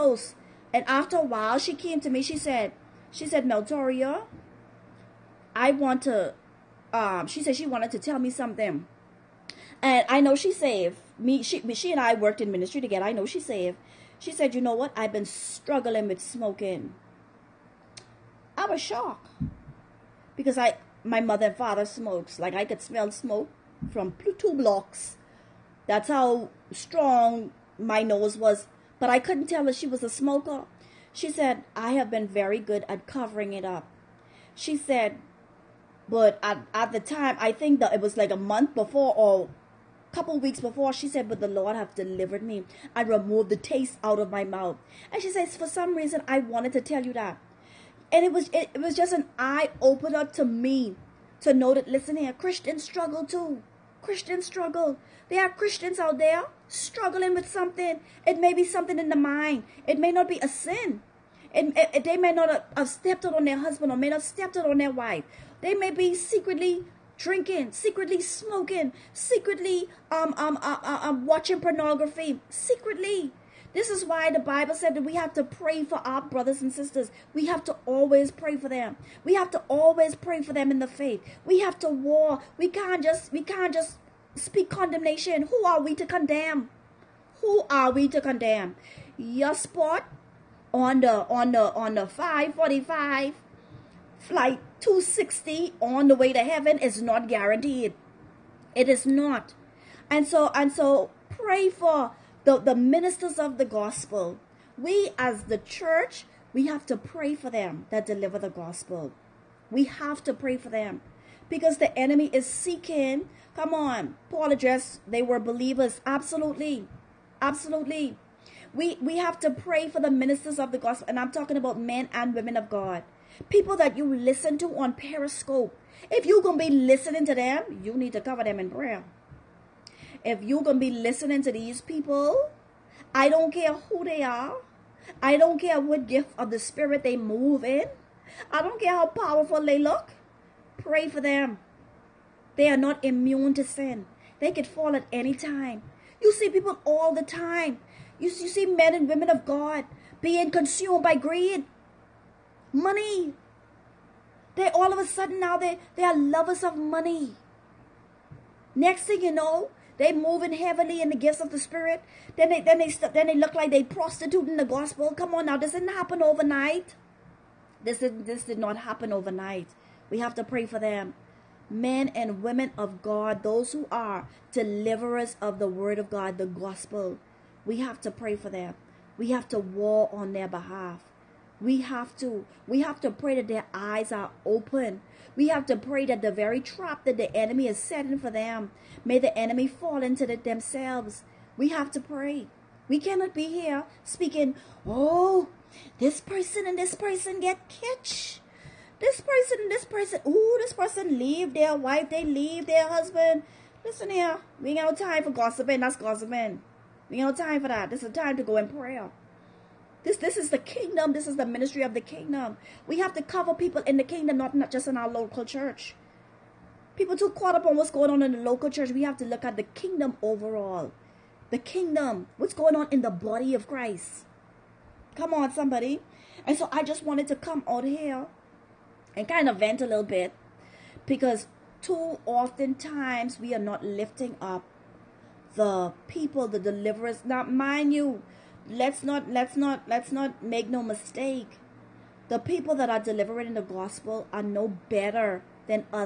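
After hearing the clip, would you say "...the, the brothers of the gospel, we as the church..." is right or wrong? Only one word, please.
wrong.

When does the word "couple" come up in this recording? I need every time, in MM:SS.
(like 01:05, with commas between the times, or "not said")
00:40.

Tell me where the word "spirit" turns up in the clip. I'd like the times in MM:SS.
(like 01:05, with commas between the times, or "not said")
02:16, 02:41.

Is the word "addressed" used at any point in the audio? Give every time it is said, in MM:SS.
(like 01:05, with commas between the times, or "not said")
01:54.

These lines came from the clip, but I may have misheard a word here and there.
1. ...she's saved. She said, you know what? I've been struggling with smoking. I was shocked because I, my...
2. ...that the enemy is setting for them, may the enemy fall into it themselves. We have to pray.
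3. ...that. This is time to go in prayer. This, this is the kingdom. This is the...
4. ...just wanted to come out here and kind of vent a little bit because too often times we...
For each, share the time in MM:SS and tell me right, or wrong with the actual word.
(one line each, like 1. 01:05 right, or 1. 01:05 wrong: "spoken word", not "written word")
1. 00:13 right
2. 03:07 right
3. 03:27 right
4. 03:46 right.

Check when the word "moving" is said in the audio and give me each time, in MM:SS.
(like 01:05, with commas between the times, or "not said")
02:40.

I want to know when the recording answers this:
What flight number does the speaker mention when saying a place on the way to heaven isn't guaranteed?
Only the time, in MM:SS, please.
01:32.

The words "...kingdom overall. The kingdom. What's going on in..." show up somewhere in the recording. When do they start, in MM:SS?
03:39.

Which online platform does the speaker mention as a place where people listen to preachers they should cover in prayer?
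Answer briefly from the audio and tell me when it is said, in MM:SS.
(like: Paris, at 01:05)
Periscope, at 02:04.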